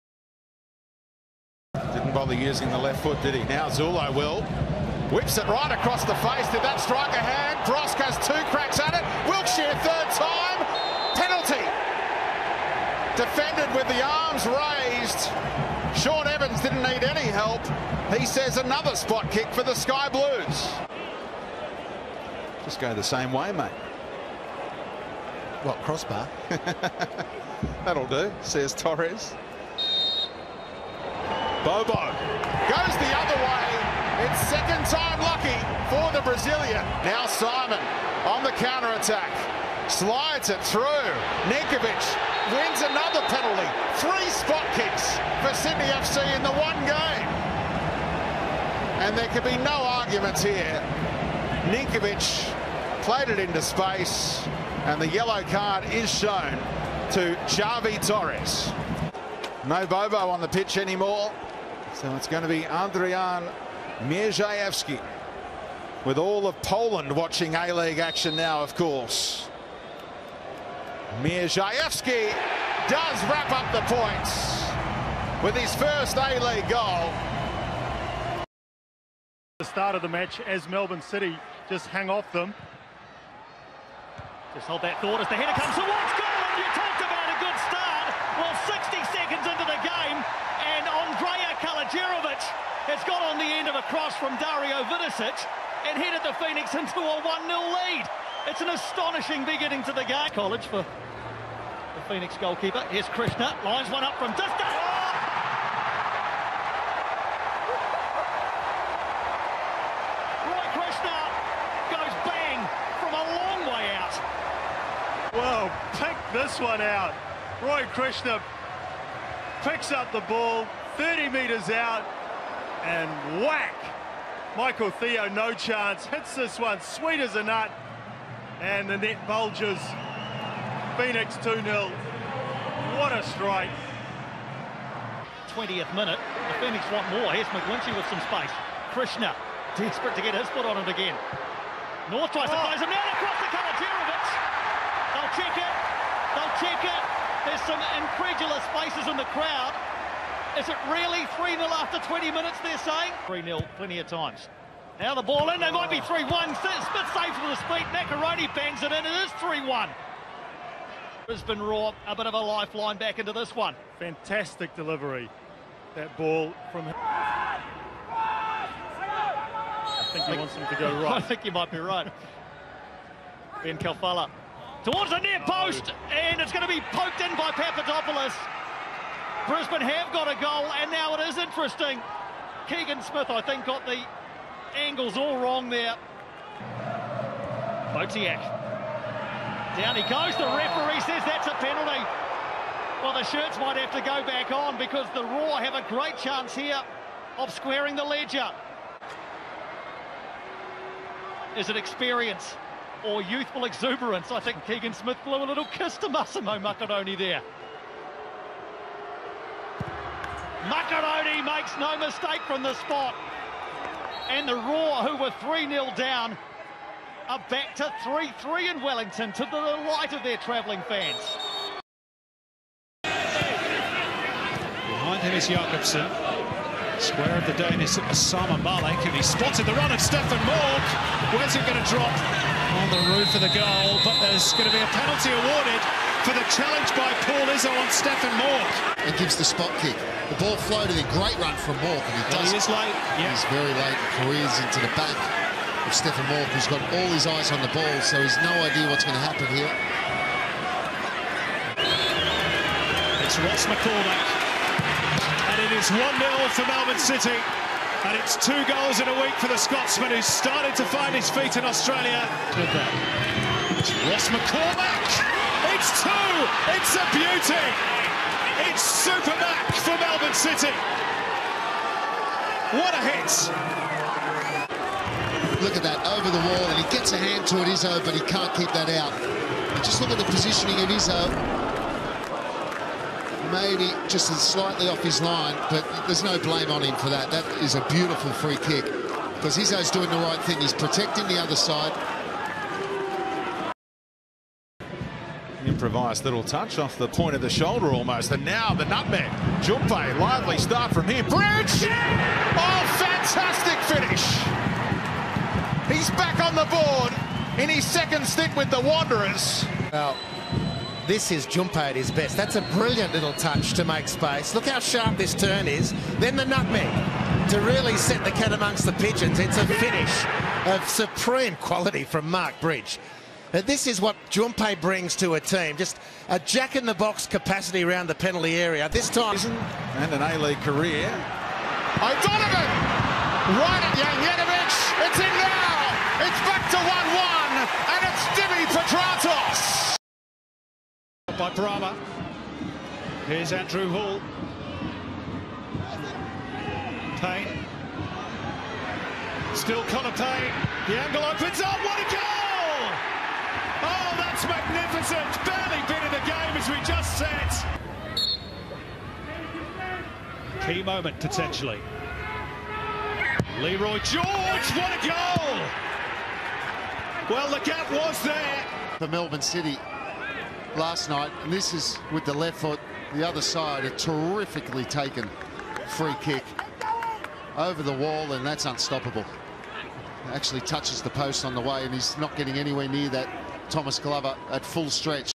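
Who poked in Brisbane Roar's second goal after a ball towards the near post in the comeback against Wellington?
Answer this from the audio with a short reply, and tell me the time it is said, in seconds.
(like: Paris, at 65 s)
Papadopoulos, at 177 s.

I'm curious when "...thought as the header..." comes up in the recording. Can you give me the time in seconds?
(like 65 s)
85 s.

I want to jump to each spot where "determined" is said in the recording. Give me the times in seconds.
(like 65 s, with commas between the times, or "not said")
not said.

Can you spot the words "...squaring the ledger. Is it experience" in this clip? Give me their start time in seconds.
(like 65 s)
197 s.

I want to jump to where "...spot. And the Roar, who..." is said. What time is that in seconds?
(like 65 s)
212 s.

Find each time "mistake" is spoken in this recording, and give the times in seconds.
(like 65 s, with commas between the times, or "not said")
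211 s.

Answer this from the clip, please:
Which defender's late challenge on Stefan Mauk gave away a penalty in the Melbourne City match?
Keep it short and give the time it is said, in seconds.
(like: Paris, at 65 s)
Paul Izzo, at 237 s.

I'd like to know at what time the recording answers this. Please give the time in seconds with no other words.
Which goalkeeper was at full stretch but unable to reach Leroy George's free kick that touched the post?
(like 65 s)
383 s.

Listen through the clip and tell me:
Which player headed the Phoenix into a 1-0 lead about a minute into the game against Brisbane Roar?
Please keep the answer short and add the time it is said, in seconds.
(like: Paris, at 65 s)
Andrija Kaluderovic, at 90 s.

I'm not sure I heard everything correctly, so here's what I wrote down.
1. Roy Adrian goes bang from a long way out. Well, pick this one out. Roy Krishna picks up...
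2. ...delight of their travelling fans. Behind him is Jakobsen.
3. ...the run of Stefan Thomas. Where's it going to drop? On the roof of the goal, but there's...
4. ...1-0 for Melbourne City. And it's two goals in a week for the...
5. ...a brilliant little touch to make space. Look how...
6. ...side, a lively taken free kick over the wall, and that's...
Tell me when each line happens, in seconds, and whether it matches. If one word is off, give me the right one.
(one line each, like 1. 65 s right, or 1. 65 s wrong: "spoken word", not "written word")
1. 110 s wrong: "Krishna", not "Adrian"
2. 219 s right
3. 229 s wrong: "Mauk", not "Thomas"
4. 255 s right
5. 312 s right
6. 373 s wrong: "terrifically", not "lively".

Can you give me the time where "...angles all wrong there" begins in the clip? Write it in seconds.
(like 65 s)
184 s.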